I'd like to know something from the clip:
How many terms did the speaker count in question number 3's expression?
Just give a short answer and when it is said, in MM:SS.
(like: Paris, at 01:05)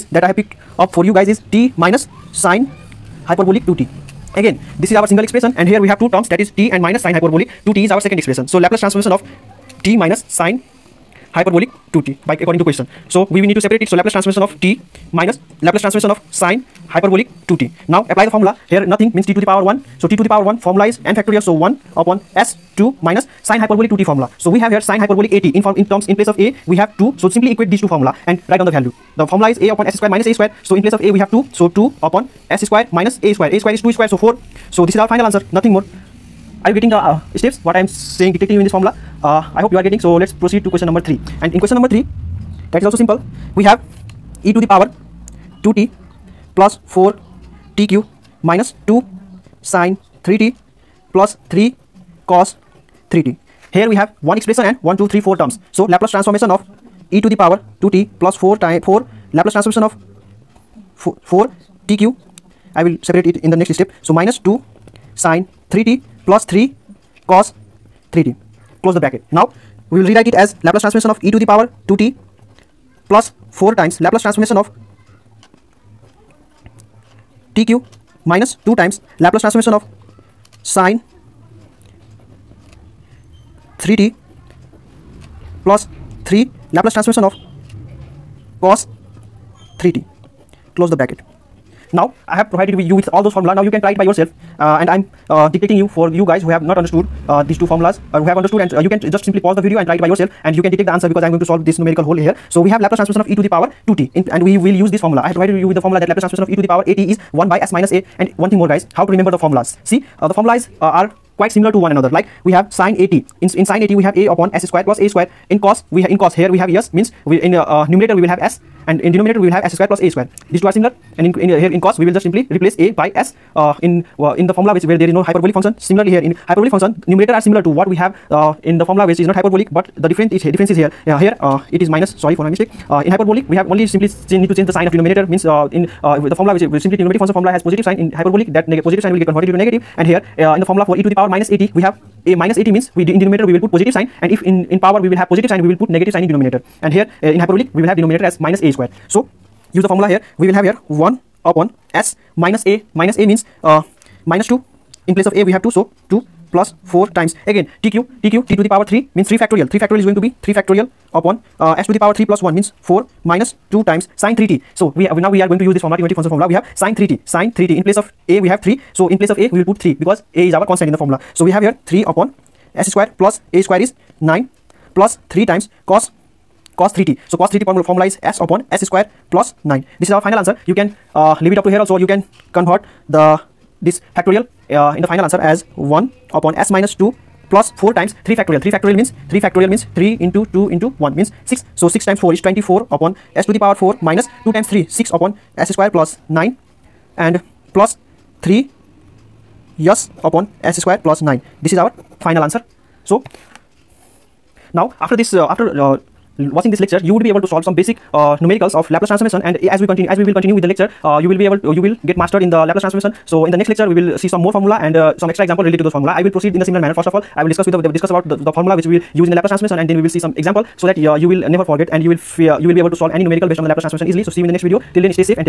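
4, at 00:54.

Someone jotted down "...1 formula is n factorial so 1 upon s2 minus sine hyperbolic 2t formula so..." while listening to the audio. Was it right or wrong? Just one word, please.
right.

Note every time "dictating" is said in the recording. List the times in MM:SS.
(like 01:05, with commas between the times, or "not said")
00:38, 01:35.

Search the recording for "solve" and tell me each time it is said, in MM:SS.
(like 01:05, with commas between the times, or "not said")
01:41, 03:27, 03:42.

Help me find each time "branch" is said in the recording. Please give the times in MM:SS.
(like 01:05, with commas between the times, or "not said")
not said.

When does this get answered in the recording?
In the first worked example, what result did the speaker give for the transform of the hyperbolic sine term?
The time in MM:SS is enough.
00:31.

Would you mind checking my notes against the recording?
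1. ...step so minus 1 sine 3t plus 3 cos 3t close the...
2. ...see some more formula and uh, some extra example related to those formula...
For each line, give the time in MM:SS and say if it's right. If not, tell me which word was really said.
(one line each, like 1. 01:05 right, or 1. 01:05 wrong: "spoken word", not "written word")
1. 01:03 wrong: "2", not "1"
2. 03:34 right.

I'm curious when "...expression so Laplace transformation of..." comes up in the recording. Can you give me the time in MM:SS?
00:08.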